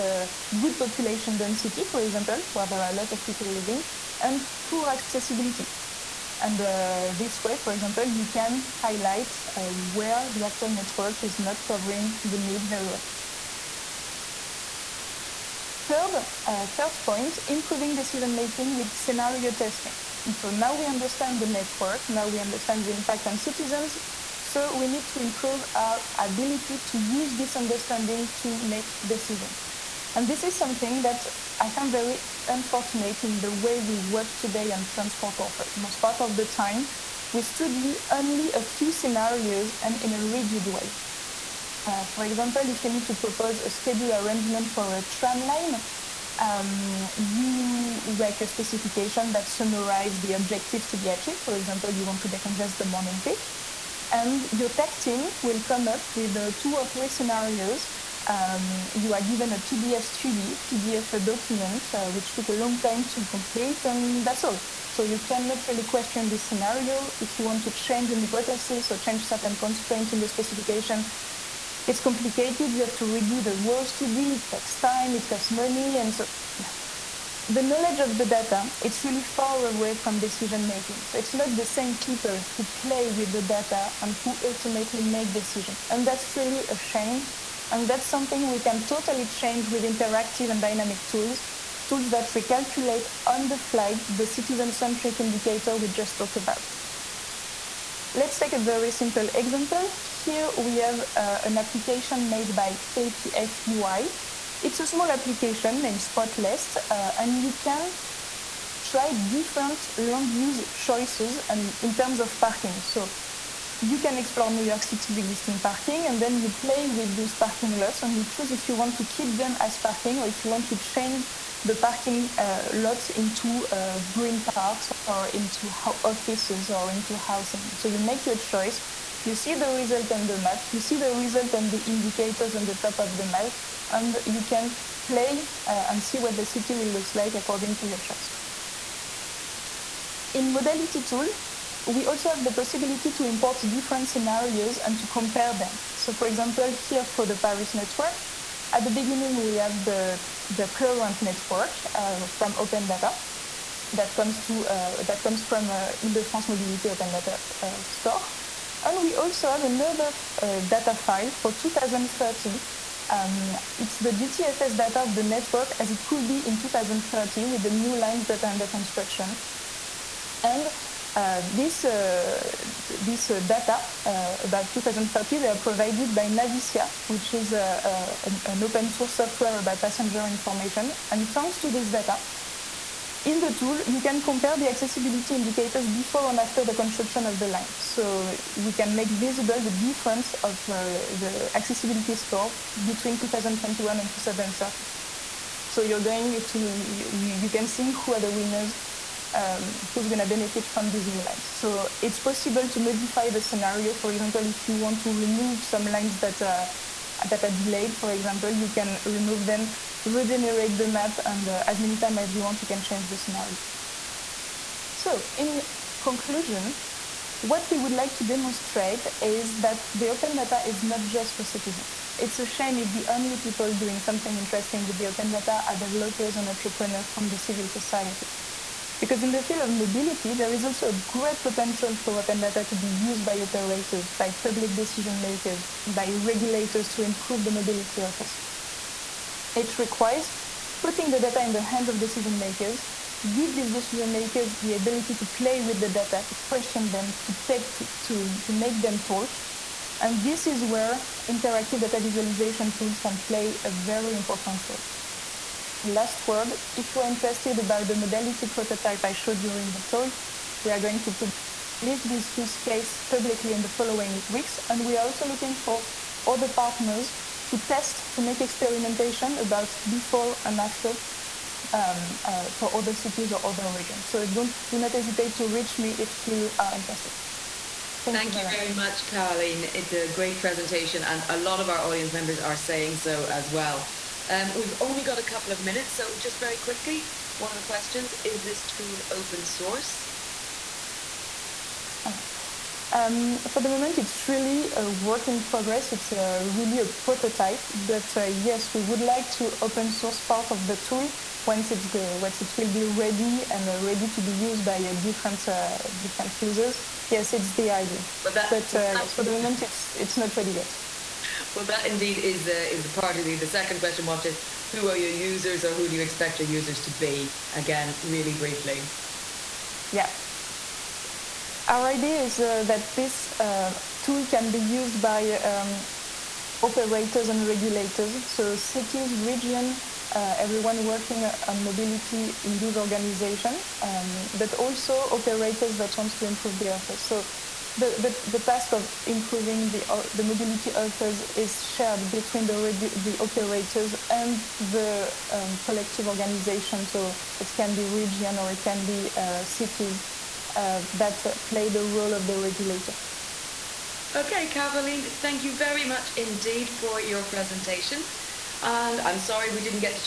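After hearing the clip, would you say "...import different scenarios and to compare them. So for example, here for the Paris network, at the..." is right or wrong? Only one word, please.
right.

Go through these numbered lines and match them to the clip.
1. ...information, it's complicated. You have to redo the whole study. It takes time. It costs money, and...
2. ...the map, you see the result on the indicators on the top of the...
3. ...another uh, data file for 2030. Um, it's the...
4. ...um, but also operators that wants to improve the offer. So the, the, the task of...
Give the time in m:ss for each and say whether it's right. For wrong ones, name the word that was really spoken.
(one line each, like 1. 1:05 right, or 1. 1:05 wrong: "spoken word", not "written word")
1. 1:10 wrong: "specification", not "information"
2. 2:10 right
3. 2:39 right
4. 5:33 right.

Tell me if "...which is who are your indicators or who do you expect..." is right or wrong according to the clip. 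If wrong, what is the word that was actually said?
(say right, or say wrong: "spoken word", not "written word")
wrong: "users", not "indicators".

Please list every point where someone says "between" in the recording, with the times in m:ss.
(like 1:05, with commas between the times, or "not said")
3:12, 5:42.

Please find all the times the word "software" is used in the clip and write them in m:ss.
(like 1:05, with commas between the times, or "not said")
2:59.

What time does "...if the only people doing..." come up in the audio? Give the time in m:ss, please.
3:42.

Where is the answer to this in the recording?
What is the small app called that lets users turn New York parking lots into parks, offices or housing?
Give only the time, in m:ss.
1:45.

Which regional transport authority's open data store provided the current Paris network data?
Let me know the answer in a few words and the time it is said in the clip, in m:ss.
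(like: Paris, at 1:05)
Ile-de-France Mobility, at 2:36.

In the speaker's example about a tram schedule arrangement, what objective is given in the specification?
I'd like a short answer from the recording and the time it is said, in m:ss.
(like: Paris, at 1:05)
Decongest the morning peak, at 0:52.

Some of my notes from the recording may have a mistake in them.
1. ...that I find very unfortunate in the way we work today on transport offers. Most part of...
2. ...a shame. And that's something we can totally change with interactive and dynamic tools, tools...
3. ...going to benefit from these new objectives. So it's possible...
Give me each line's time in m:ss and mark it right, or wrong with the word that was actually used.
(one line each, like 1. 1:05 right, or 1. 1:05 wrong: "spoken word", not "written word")
1. 0:31 right
2. 1:26 right
3. 3:20 wrong: "lines", not "objectives".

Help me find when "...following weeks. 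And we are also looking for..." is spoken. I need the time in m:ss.
4:23.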